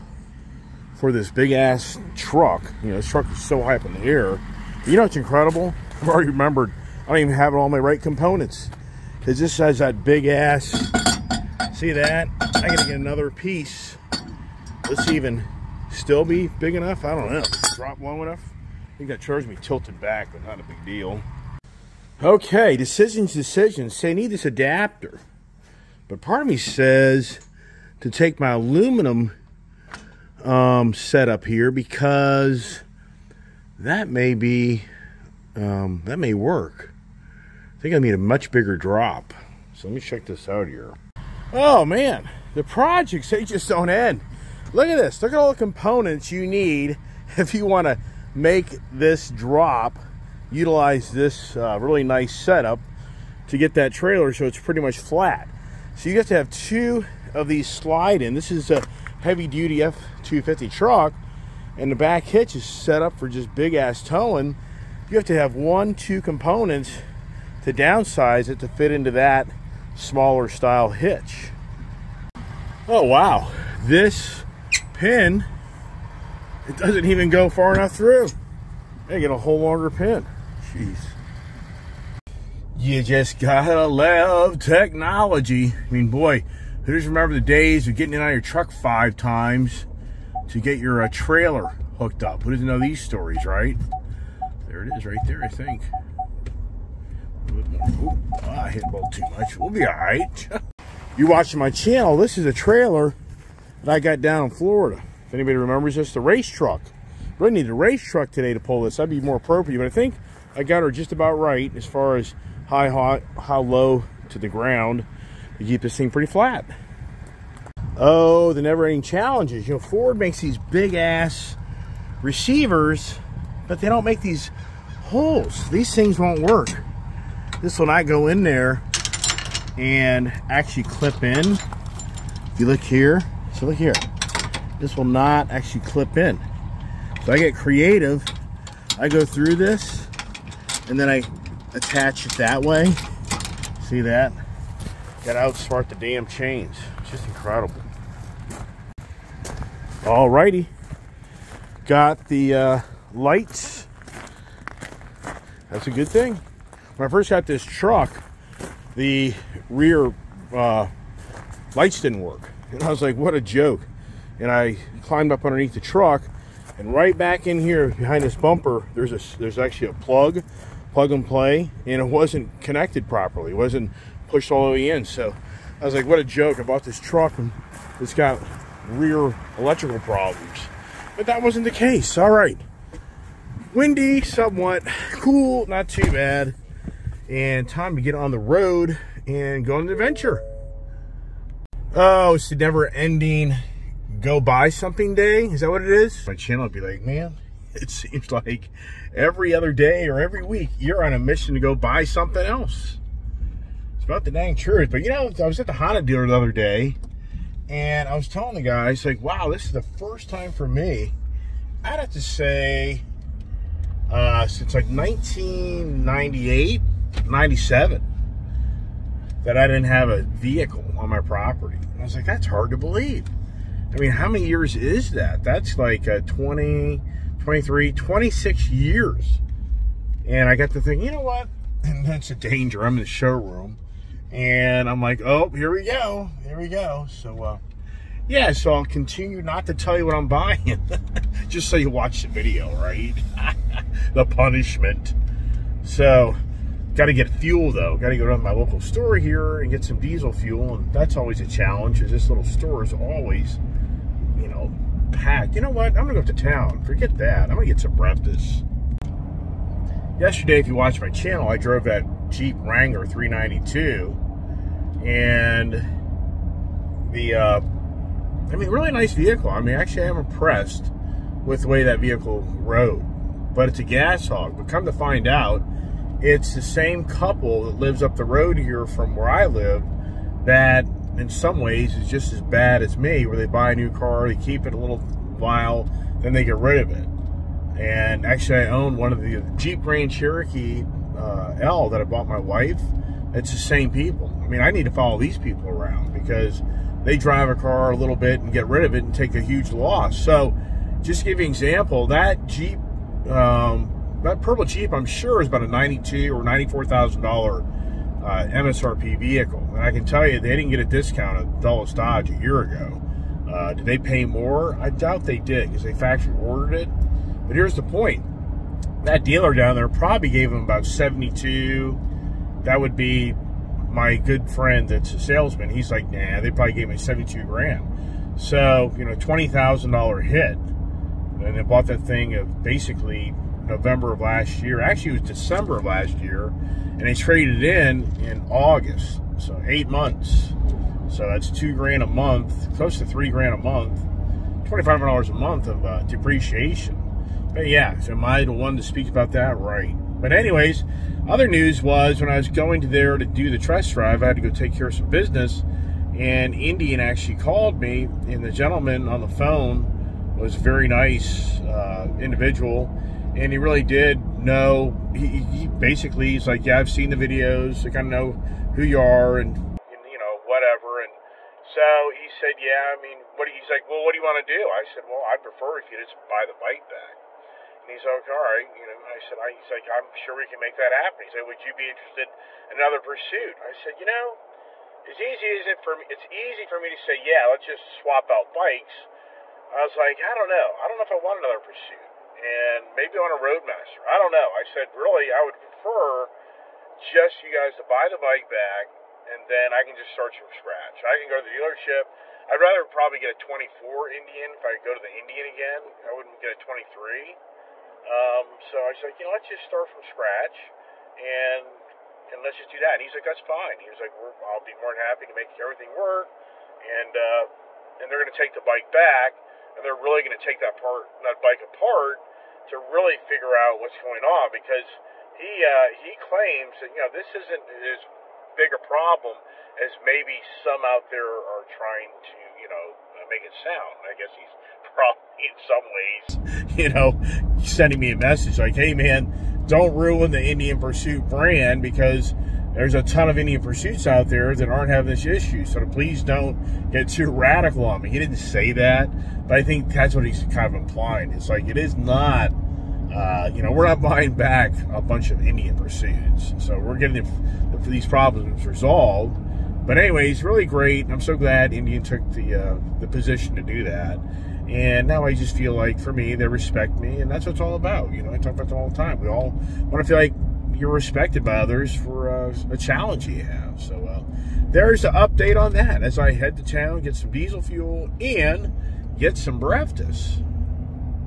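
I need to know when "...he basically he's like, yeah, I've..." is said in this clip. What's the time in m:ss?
6:05.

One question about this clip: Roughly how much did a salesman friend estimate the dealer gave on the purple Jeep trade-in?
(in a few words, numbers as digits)
72.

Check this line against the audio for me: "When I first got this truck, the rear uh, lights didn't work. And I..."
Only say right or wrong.
right.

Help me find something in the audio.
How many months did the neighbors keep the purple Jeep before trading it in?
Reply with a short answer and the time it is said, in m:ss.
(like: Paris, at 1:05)
8, at 5:39.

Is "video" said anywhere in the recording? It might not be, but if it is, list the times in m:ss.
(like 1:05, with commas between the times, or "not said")
4:02, 6:07.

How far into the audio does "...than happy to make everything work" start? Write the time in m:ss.
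6:54.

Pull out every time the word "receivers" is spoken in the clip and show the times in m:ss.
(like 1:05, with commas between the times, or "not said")
2:02.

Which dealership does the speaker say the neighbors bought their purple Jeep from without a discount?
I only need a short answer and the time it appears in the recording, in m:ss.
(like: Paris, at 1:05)
Dulles Dodge, at 5:11.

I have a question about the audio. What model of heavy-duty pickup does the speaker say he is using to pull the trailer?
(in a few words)
F-250.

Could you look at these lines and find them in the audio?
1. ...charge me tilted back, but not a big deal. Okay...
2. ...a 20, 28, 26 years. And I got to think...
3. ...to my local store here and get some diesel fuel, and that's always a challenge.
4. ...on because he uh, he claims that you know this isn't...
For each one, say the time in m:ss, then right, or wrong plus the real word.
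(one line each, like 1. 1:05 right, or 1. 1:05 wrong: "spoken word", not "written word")
1. 0:19 right
2. 3:46 wrong: "23", not "28"
3. 4:08 right
4. 7:04 right.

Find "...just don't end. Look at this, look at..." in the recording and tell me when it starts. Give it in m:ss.
0:43.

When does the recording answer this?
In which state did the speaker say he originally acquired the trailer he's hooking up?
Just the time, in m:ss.
1:44.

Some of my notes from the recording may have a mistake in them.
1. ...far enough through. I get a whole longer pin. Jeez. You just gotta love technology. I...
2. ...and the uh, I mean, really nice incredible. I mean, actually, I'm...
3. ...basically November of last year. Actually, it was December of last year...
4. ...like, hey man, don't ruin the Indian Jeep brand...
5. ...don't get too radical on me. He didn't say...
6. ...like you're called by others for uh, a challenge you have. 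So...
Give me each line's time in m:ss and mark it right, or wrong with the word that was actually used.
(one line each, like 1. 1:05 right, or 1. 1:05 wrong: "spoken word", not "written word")
1. 1:17 right
2. 4:25 wrong: "vehicle", not "incredible"
3. 5:32 right
4. 7:18 wrong: "Pursuit", not "Jeep"
5. 7:26 right
6. 7:50 wrong: "respected", not "called".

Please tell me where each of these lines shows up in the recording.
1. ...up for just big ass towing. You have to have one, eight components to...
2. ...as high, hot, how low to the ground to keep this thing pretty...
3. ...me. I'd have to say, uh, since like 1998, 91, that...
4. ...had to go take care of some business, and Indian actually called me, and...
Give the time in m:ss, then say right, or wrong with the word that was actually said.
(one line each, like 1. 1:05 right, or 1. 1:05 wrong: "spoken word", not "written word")
1. 1:03 wrong: "two", not "eight"
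2. 1:52 right
3. 3:30 wrong: "97", not "91"
4. 5:54 right.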